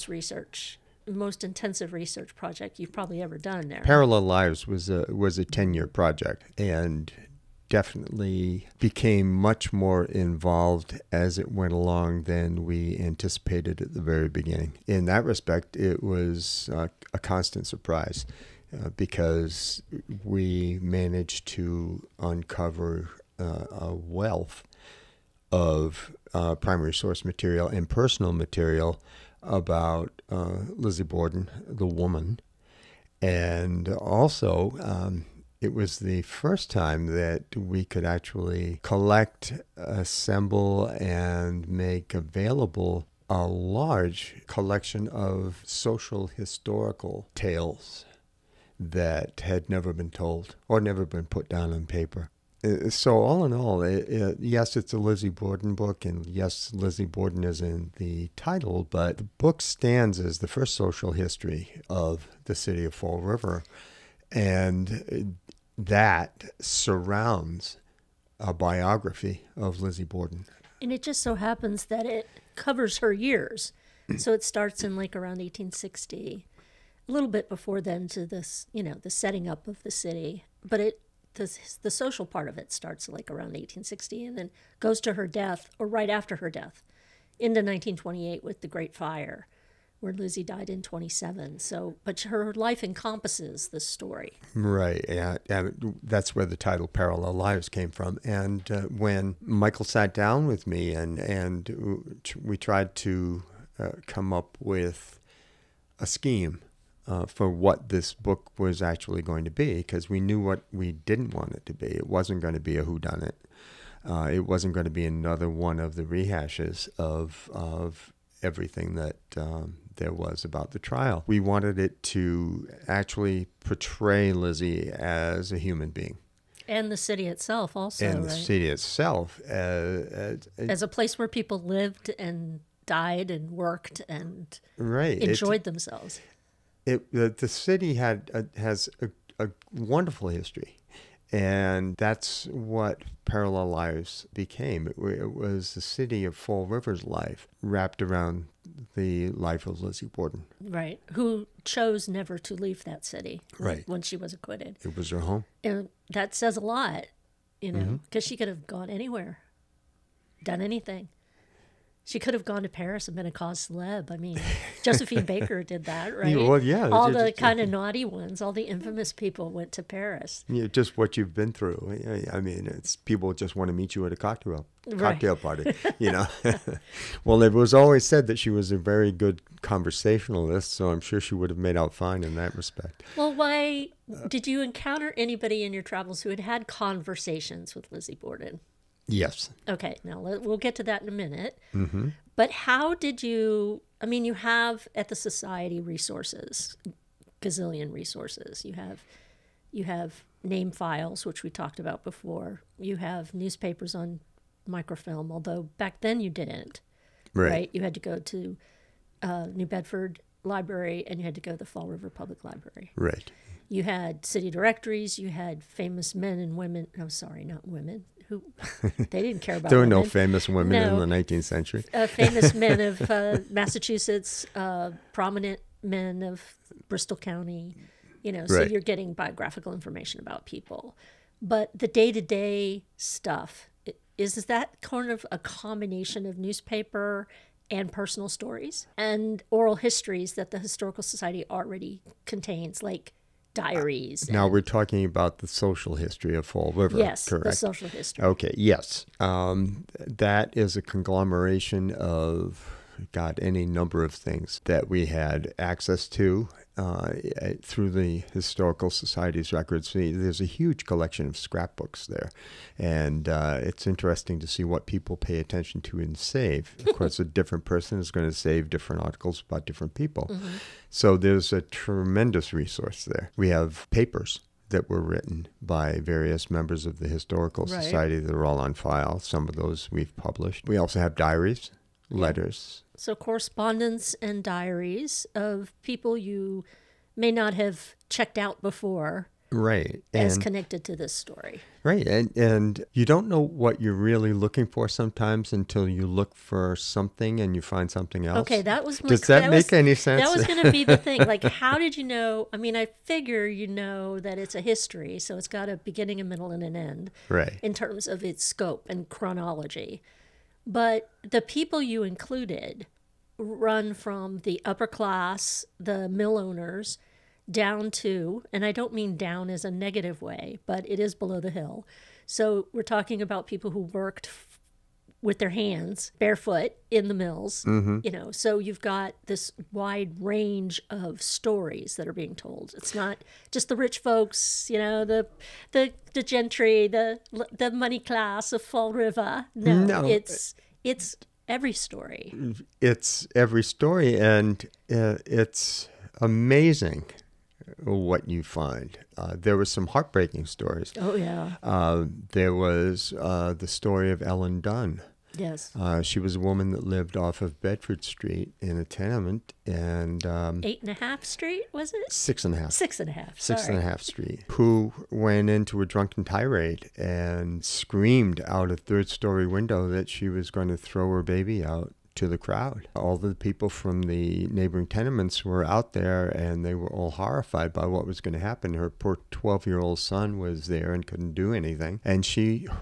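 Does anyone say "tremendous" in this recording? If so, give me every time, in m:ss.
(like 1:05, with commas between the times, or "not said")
4:31.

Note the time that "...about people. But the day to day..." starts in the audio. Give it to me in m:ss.
3:50.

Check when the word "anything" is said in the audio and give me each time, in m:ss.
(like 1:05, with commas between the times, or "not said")
2:40, 6:21.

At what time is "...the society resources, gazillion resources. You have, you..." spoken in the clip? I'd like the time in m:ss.
3:15.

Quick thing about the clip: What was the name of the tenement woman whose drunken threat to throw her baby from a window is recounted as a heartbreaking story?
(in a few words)
Ellen Dunn.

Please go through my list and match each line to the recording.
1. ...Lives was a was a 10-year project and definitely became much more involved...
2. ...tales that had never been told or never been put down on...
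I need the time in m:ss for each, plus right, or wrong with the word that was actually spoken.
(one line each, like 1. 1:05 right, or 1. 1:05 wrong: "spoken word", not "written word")
1. 0:04 right
2. 0:47 right.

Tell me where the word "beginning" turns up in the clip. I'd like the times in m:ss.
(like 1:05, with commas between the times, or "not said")
0:14, 5:05.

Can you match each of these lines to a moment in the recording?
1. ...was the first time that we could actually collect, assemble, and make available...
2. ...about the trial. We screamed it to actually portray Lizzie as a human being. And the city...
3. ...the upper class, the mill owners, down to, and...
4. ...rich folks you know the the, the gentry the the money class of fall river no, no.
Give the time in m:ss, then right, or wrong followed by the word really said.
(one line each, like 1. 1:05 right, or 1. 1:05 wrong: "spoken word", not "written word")
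1. 0:35 right
2. 2:00 wrong: "wanted", not "screamed"
3. 5:14 right
4. 5:33 right.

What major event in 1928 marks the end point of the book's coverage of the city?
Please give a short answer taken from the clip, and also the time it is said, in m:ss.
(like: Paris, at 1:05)
the Great Fire, at 1:28.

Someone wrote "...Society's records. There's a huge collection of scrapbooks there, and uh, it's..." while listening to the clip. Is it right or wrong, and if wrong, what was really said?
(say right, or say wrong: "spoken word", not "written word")
right.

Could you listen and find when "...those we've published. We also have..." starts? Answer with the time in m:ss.
4:39.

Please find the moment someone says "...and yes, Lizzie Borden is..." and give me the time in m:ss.
0:56.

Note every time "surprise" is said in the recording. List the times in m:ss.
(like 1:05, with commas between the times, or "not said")
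0:17.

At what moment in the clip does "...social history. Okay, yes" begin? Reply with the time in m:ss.
4:07.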